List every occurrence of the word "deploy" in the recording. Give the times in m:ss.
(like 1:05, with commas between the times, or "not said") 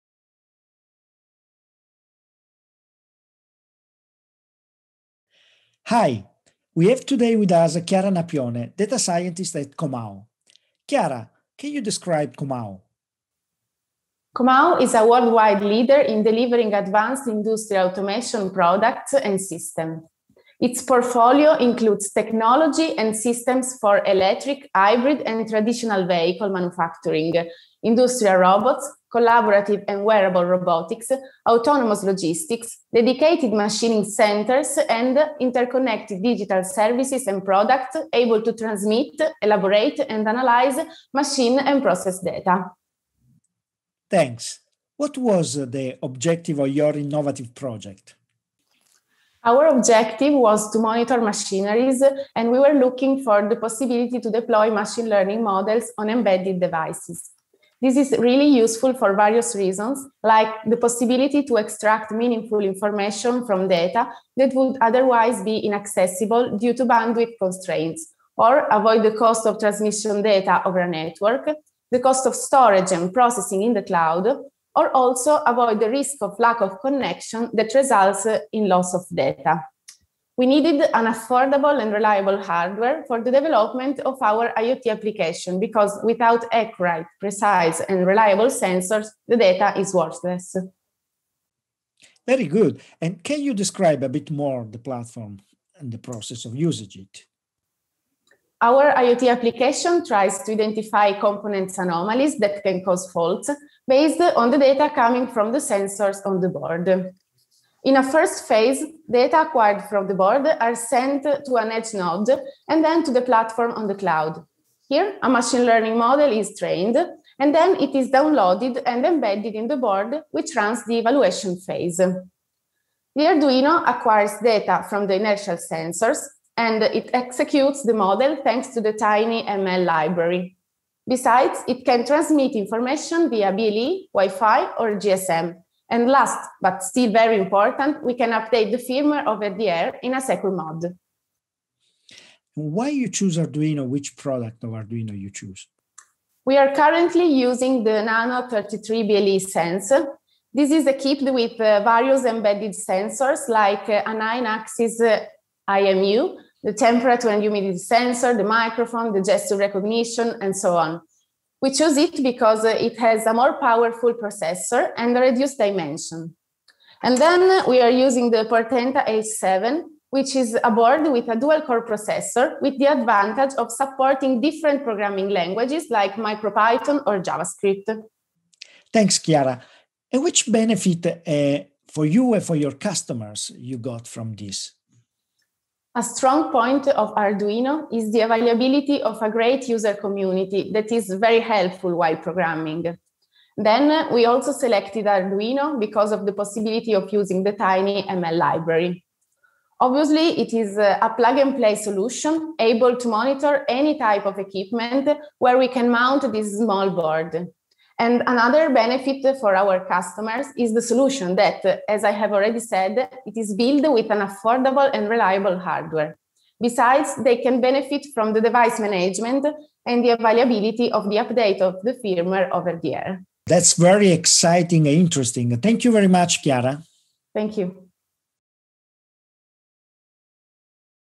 0:54.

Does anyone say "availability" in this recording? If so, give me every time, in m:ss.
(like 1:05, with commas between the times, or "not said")
3:08, 3:40.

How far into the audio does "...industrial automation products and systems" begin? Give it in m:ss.
0:17.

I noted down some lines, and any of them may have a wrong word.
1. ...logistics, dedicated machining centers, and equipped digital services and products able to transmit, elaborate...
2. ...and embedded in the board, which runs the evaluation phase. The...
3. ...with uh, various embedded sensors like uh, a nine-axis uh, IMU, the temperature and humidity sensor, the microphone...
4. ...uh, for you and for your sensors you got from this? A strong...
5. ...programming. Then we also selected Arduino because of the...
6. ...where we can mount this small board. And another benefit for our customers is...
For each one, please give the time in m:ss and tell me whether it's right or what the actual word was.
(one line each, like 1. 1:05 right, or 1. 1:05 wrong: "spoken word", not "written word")
1. 0:32 wrong: "interconnected", not "equipped"
2. 1:58 right
3. 2:31 right
4. 3:01 wrong: "customers", not "sensors"
5. 3:12 right
6. 3:25 right.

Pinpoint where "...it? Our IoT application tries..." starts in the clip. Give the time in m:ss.
1:36.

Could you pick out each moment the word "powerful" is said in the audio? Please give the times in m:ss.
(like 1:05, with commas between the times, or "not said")
2:43.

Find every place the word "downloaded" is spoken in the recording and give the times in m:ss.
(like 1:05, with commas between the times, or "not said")
1:58.